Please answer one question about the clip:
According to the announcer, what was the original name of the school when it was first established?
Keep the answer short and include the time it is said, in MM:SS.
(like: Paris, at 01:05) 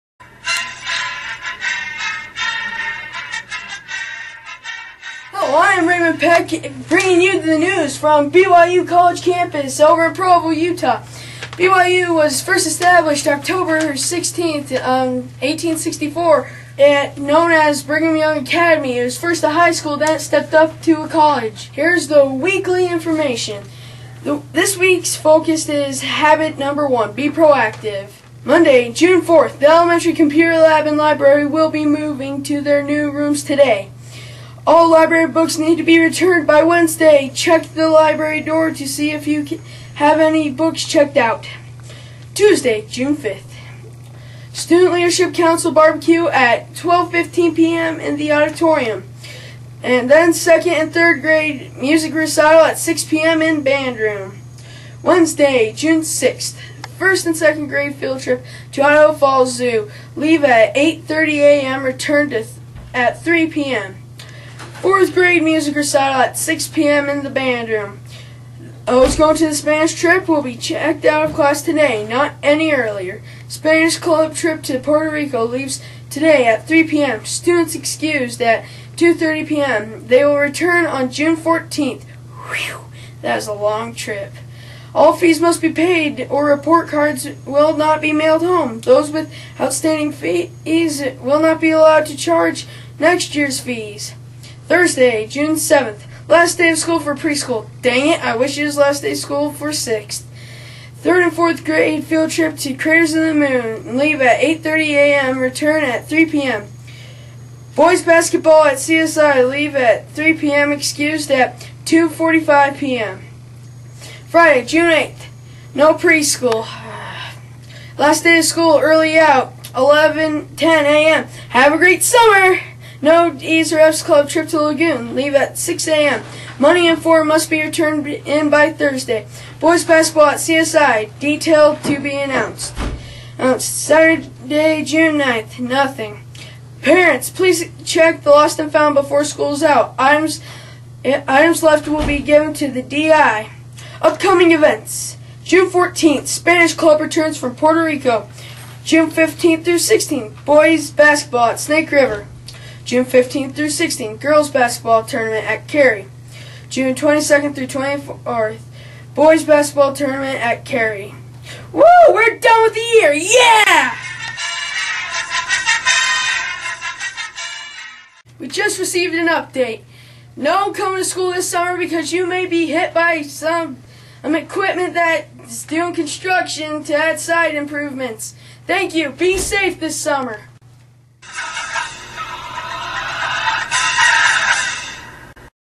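Brigham Young Academy, at 00:17.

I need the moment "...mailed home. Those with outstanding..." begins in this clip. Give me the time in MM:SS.
01:28.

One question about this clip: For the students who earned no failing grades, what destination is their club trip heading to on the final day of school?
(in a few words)
Lagoon.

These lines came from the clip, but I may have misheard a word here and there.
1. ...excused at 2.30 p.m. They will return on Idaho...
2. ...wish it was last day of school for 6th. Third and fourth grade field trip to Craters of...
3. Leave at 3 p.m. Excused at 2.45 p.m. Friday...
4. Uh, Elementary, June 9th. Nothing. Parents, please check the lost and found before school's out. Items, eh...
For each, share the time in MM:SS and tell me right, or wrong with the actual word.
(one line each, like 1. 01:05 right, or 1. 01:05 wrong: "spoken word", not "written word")
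1. 01:17 wrong: "June", not "Idaho"
2. 01:38 right
3. 01:49 right
4. 02:13 wrong: "Saturday", not "Elementary".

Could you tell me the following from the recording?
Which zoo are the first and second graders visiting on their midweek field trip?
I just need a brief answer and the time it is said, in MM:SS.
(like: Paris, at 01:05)
Idaho Falls Zoo, at 00:58.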